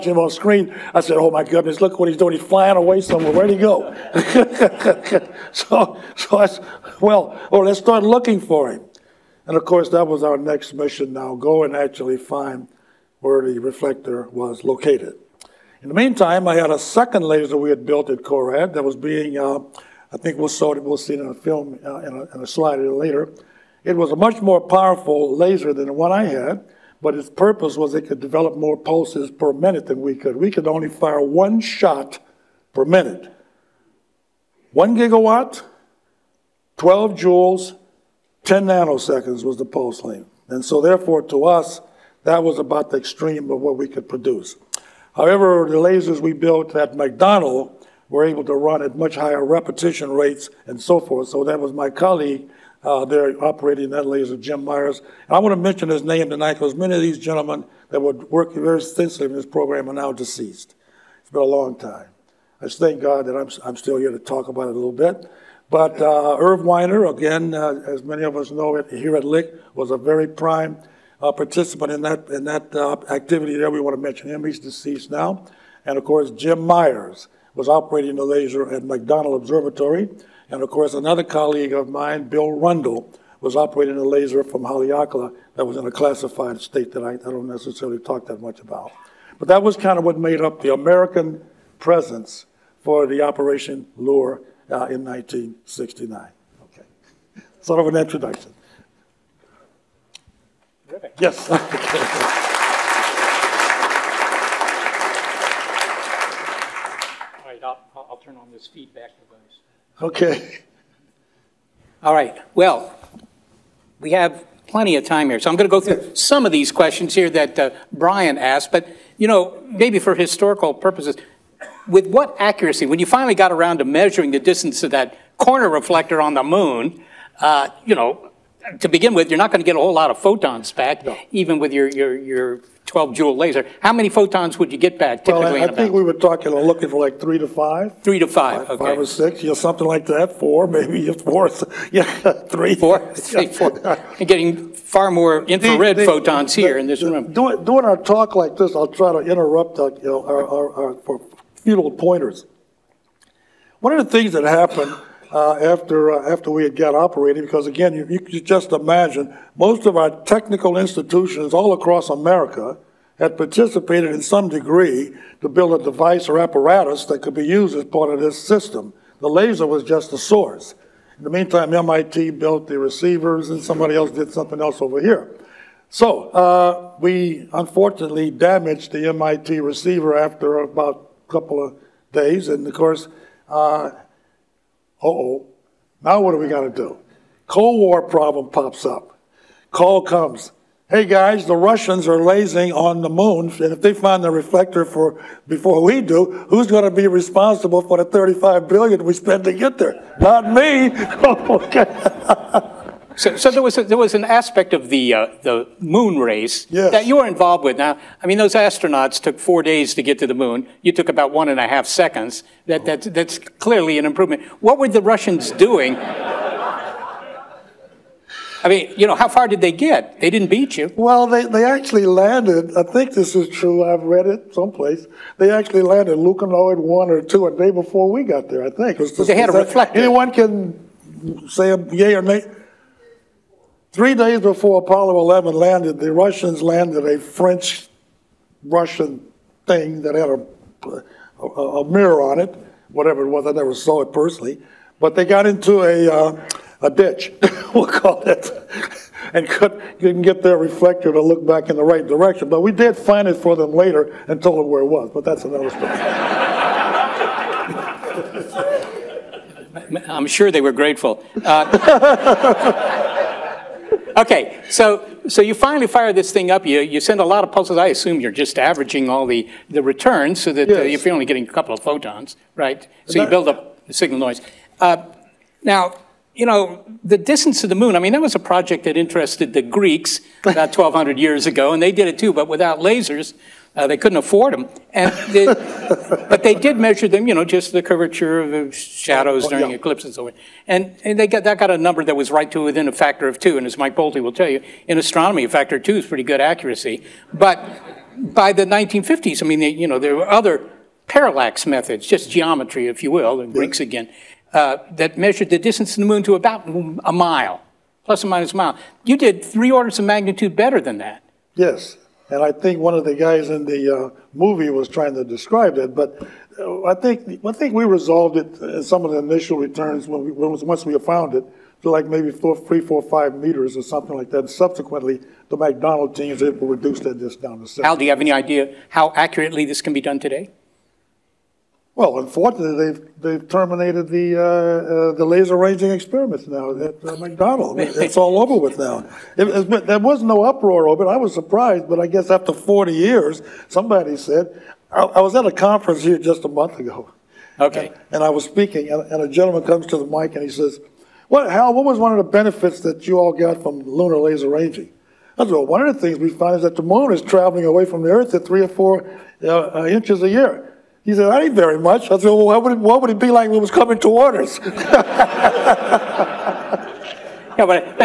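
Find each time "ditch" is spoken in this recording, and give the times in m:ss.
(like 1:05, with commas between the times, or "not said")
4:06.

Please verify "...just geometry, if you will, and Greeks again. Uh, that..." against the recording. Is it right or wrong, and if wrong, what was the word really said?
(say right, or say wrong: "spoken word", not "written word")
right.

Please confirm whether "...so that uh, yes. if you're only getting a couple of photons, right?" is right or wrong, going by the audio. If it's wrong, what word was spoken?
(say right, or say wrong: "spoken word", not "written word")
right.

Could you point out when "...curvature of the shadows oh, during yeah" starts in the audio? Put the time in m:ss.
4:47.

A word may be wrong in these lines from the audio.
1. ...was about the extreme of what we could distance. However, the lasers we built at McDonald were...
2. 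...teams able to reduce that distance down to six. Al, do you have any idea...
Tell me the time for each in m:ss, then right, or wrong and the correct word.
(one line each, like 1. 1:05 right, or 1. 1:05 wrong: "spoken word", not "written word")
1. 0:42 wrong: "produce", not "distance"
2. 5:26 right.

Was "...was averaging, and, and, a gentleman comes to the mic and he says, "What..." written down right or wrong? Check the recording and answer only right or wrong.
wrong.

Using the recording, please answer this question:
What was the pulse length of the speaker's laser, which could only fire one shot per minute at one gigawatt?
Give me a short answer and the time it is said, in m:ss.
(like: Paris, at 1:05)
10 nanoseconds, at 0:38.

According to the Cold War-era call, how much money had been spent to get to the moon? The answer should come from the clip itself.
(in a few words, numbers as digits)
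35 billion.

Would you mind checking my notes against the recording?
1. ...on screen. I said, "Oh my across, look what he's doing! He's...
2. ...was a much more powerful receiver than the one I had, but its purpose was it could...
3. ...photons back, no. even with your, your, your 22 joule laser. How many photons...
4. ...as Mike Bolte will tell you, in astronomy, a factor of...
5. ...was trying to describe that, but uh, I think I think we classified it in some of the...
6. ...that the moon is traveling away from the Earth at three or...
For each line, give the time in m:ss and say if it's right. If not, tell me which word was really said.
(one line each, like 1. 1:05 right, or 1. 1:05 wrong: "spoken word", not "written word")
1. 0:00 wrong: "goodness", not "across"
2. 0:23 wrong: "laser", not "receiver"
3. 2:10 wrong: "12", not "22"
4. 4:53 right
5. 5:14 wrong: "resolved", not "classified"
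6. 5:56 right.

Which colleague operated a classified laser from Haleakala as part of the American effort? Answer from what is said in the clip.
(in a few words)
Bill Rundle.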